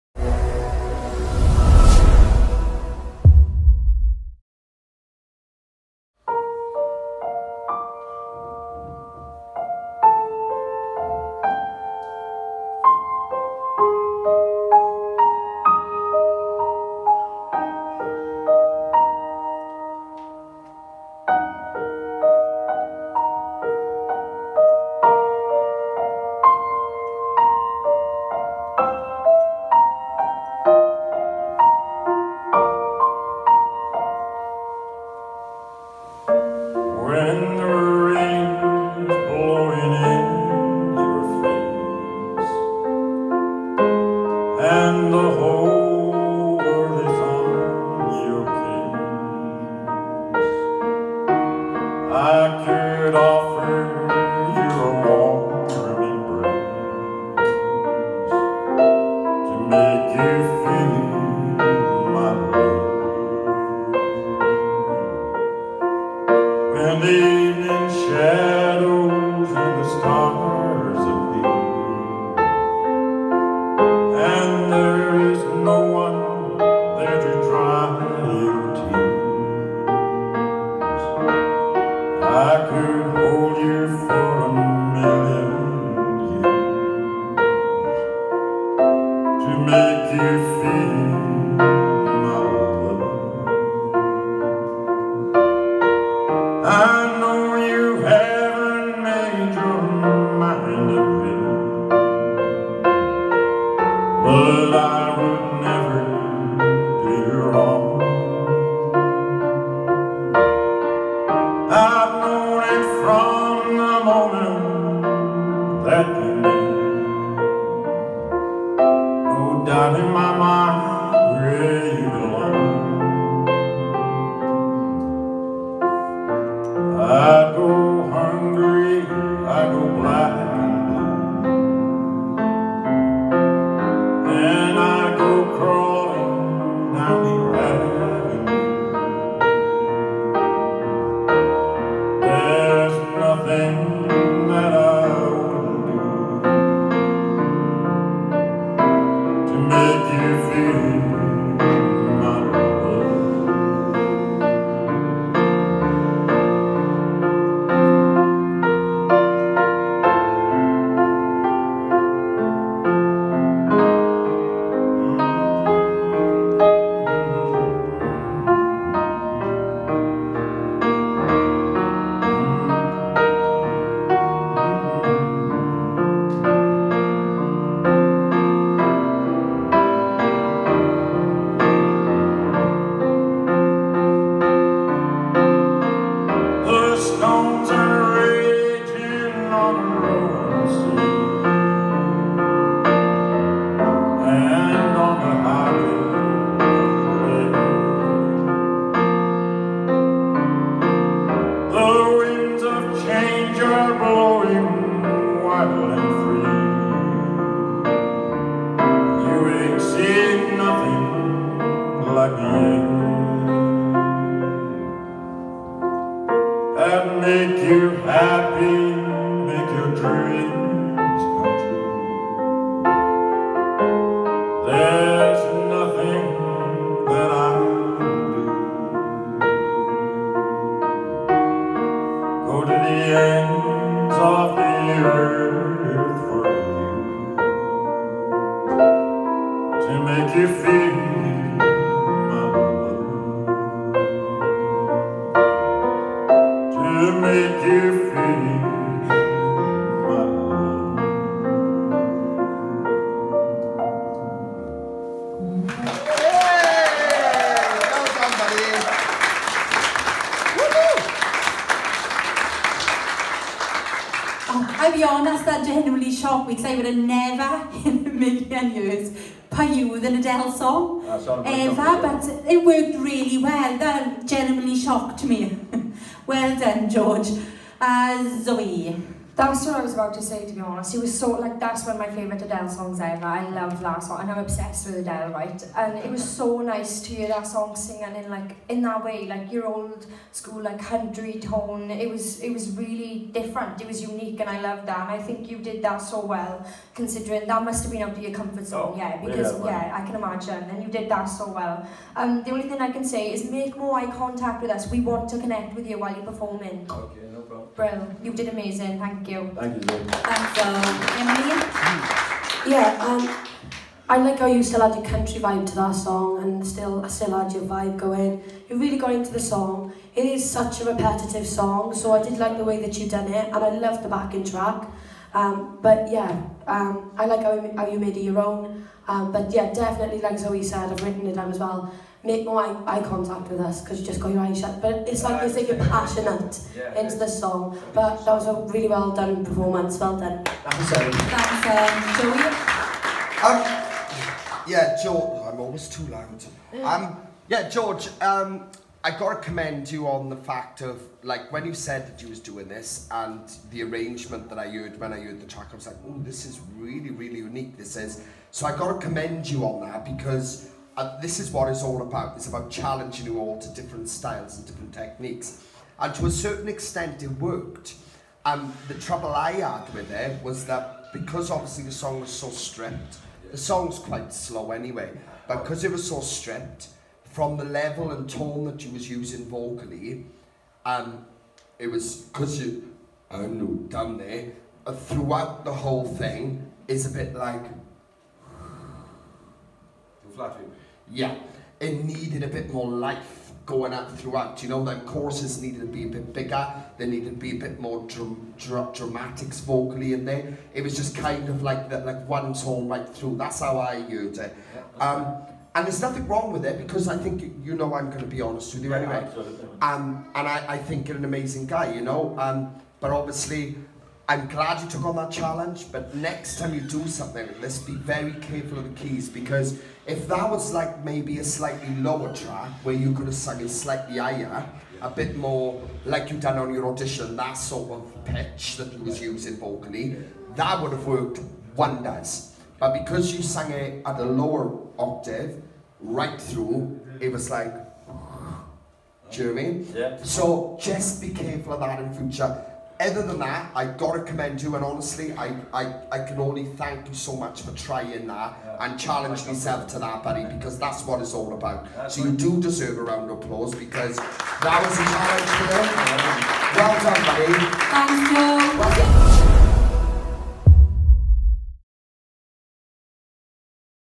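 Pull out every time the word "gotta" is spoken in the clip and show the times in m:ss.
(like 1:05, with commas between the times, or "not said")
5:49, 5:58.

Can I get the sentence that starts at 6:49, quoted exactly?
Um, and I, I think you're an amazing guy, you know.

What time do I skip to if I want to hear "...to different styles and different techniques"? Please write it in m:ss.
6:03.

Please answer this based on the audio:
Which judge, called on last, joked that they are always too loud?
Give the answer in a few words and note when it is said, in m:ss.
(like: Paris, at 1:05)
Joey, at 5:42.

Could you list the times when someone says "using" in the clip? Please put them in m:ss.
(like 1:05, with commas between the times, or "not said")
6:19, 7:09.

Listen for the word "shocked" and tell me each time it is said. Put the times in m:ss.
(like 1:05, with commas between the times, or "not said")
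4:26, 4:34.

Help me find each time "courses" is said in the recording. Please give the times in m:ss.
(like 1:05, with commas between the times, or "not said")
6:35.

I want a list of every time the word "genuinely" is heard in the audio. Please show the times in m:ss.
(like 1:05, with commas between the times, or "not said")
4:25, 4:34.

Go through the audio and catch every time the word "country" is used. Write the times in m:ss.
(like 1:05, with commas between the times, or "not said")
4:50, 5:15.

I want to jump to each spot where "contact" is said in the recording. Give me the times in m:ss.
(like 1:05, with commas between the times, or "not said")
5:04, 5:33.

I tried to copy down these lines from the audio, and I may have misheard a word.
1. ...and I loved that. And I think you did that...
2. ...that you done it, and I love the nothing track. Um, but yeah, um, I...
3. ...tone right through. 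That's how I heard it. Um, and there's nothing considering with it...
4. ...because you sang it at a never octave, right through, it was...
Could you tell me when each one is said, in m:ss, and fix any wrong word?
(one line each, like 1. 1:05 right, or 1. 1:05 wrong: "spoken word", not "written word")
1. 4:54 right
2. 5:22 wrong: "backing", not "nothing"
3. 6:42 wrong: "wrong", not "considering"
4. 7:13 wrong: "lower", not "never".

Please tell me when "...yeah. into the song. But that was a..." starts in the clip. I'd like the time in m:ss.
5:36.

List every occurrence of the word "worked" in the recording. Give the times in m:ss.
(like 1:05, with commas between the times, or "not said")
4:32, 6:07, 7:11.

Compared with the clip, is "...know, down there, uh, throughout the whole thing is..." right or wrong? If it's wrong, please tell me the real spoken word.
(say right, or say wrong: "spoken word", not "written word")
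right.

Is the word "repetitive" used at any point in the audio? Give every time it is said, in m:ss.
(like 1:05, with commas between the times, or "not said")
5:20.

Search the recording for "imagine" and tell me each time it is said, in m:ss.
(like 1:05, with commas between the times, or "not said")
5:00.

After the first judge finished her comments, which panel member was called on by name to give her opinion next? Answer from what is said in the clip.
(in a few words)
Emily.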